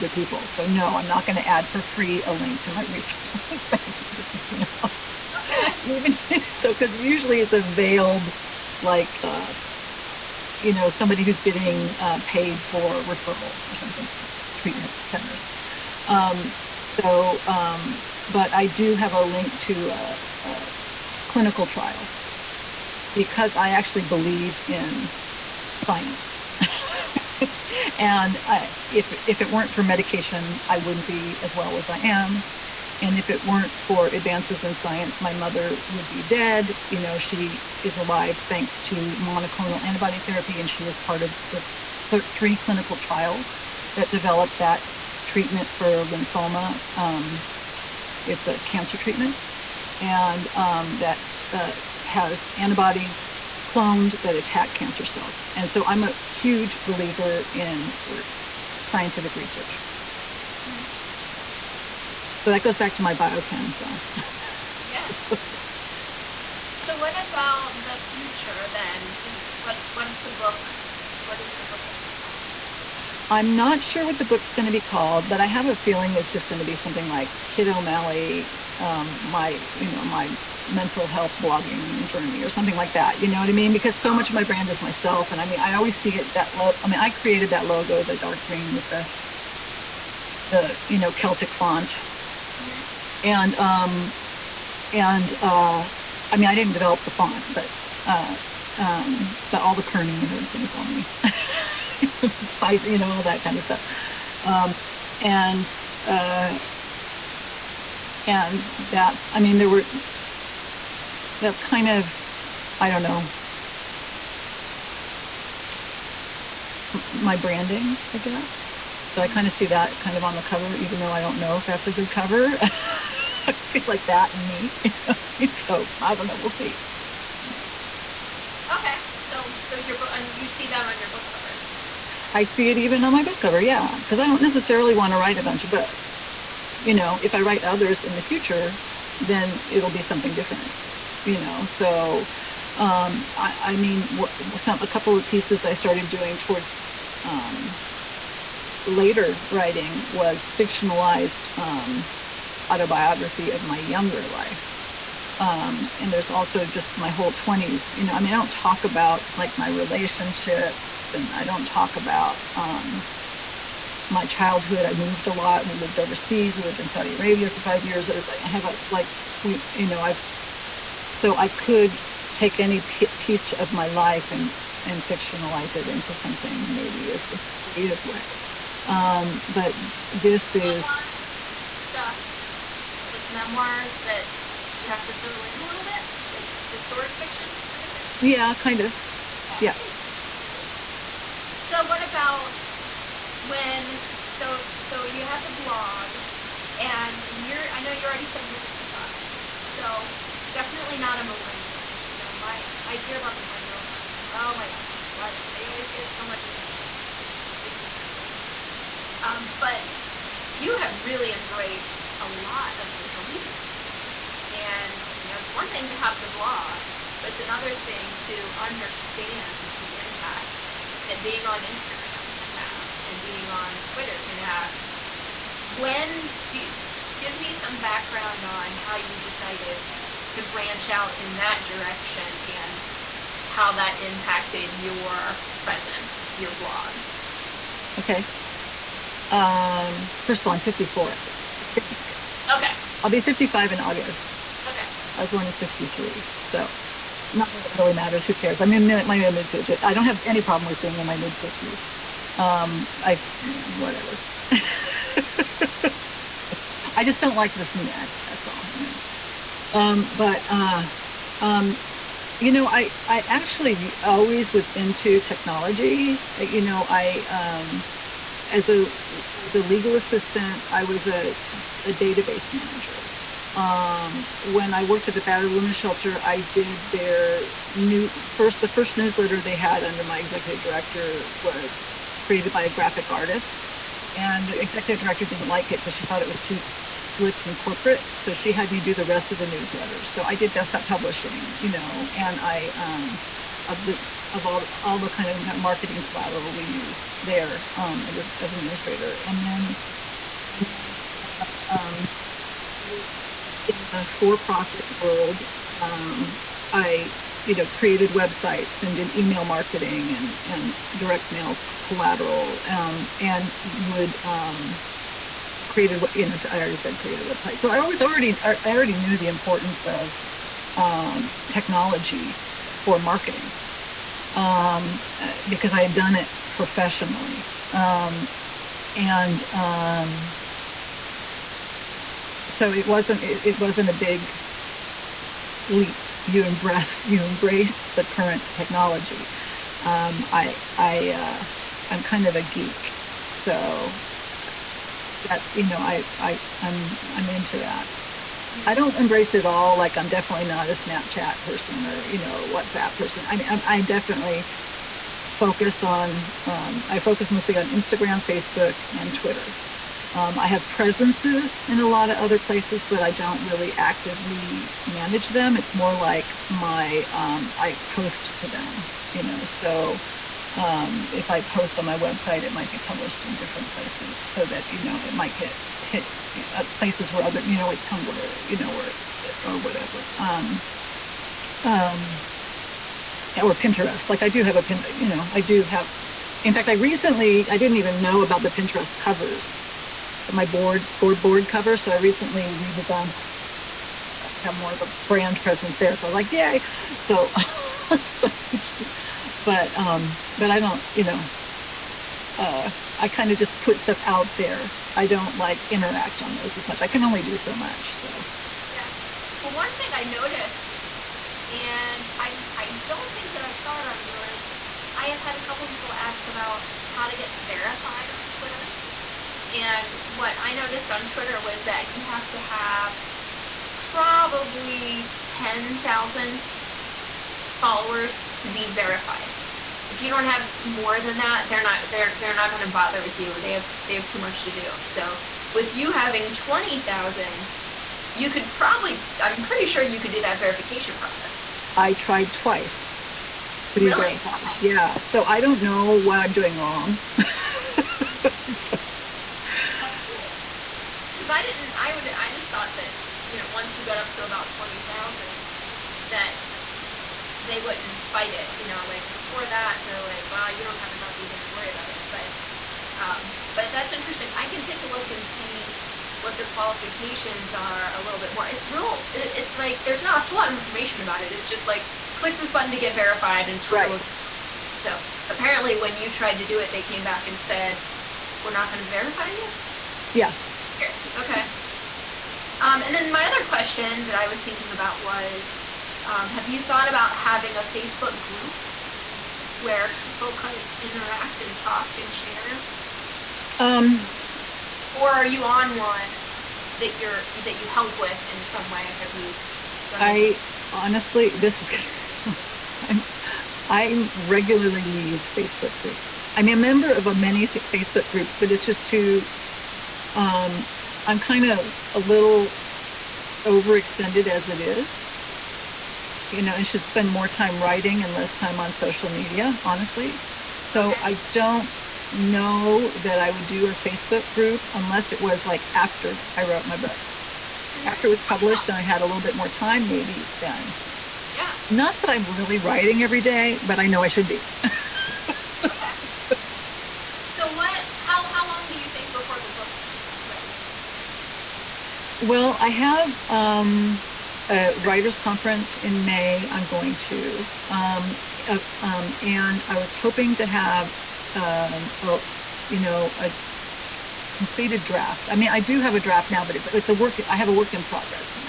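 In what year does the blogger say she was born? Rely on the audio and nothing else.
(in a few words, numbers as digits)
1963.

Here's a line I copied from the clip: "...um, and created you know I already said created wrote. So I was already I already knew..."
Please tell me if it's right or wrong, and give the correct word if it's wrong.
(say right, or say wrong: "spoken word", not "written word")
wrong: "website", not "wrote".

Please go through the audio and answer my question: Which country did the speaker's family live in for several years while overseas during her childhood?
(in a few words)
Saudi Arabia.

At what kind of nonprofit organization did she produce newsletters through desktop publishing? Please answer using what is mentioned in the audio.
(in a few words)
Battered Women's Shelter.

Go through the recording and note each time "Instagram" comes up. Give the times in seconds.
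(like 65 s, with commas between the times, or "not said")
221 s, 357 s.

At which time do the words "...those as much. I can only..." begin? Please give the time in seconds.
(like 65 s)
406 s.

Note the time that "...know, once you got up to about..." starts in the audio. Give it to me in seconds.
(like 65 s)
453 s.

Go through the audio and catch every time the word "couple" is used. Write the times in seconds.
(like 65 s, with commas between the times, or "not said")
144 s, 415 s.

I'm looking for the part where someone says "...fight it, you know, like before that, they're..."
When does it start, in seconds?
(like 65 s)
458 s.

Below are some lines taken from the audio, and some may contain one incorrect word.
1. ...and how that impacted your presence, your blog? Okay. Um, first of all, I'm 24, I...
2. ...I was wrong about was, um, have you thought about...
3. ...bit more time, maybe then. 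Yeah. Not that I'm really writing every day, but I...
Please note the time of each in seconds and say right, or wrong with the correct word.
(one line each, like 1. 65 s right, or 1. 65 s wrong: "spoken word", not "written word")
1. 232 s wrong: "54", not "24"
2. 484 s wrong: "thinking", not "wrong"
3. 529 s right.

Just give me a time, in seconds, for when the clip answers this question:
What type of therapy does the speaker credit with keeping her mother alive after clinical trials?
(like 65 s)
39 s.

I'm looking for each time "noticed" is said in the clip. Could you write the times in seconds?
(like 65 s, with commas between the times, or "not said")
410 s, 420 s.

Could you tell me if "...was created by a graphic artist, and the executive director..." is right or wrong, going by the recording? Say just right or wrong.
right.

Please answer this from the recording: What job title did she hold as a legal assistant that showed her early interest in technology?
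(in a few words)
Database manager.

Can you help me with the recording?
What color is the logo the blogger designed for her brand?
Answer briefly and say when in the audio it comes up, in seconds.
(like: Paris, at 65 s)
Dark green, at 88 s.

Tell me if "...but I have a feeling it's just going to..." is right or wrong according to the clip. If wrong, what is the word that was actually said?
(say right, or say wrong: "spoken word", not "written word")
right.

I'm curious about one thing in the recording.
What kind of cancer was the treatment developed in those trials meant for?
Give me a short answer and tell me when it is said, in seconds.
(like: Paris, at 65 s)
Lymphoma, at 46 s.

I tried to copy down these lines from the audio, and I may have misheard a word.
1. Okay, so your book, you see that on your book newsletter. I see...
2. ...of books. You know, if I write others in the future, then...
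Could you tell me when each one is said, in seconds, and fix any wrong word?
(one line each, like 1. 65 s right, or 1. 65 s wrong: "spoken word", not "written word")
1. 128 s wrong: "cover", not "newsletter"
2. 135 s right.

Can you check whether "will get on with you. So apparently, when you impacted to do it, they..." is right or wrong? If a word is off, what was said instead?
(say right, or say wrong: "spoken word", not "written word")
wrong: "tried", not "impacted".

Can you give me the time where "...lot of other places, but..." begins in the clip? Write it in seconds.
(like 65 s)
361 s.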